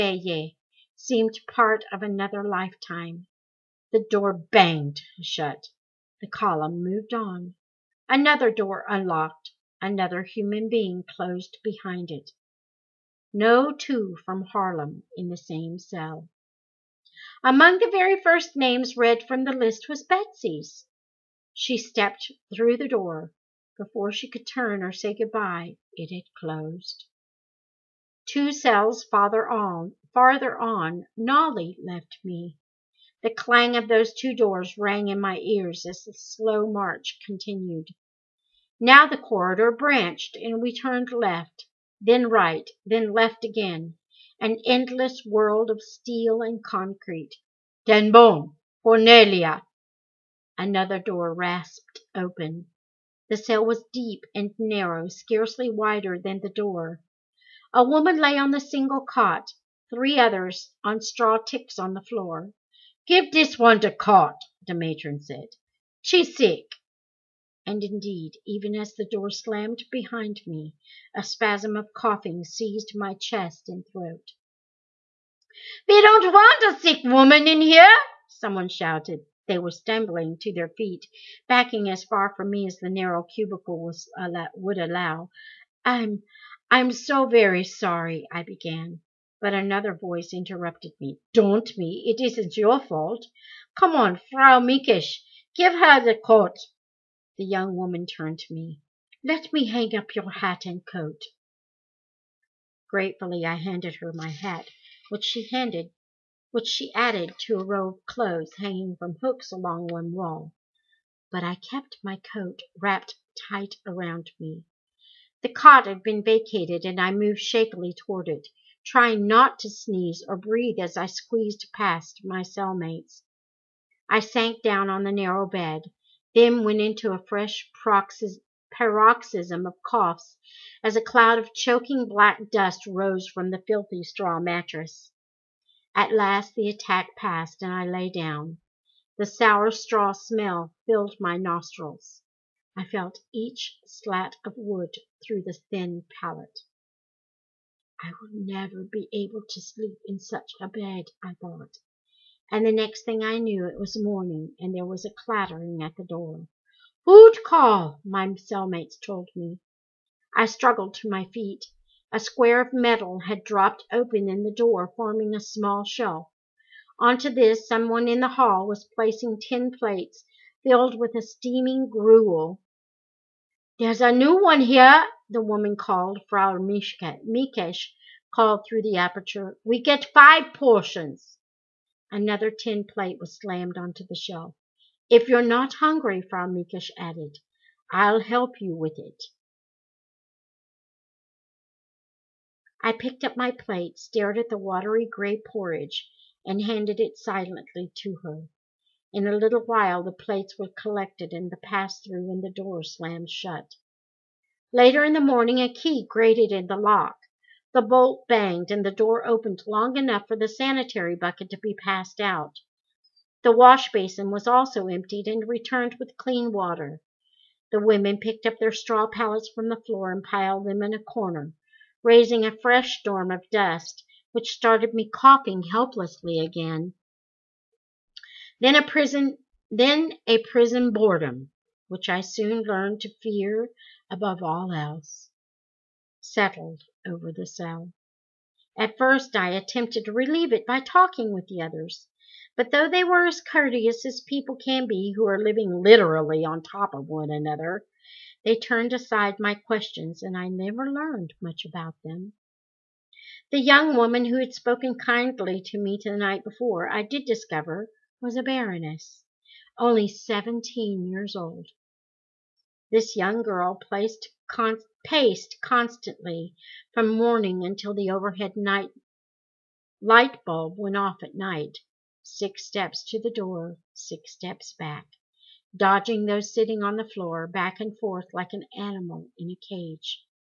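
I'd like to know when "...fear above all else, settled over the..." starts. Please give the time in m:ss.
3:53.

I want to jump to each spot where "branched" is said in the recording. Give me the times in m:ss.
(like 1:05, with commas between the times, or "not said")
0:39.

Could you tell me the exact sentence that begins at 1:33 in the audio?
Come on, Frau Mickisch, give her the coat.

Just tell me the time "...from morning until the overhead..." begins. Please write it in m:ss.
4:26.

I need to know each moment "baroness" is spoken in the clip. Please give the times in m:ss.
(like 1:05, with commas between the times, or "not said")
4:18.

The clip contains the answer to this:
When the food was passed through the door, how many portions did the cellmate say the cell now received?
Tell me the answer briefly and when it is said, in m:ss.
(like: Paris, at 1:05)
5, at 3:00.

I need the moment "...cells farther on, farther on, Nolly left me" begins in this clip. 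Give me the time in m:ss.
0:28.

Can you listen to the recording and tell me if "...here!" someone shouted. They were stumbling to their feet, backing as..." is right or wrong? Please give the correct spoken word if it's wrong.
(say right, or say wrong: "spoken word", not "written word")
right.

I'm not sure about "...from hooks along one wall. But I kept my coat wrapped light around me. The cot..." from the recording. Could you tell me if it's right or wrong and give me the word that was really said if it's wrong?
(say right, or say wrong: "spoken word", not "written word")
wrong: "tight", not "light".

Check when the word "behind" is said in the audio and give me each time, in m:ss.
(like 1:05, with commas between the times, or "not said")
0:11, 1:09.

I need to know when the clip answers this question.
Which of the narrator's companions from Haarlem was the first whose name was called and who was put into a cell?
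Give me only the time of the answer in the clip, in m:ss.
0:20.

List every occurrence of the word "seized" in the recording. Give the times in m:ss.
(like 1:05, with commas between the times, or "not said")
1:12.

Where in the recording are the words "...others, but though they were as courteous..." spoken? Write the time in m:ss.
4:01.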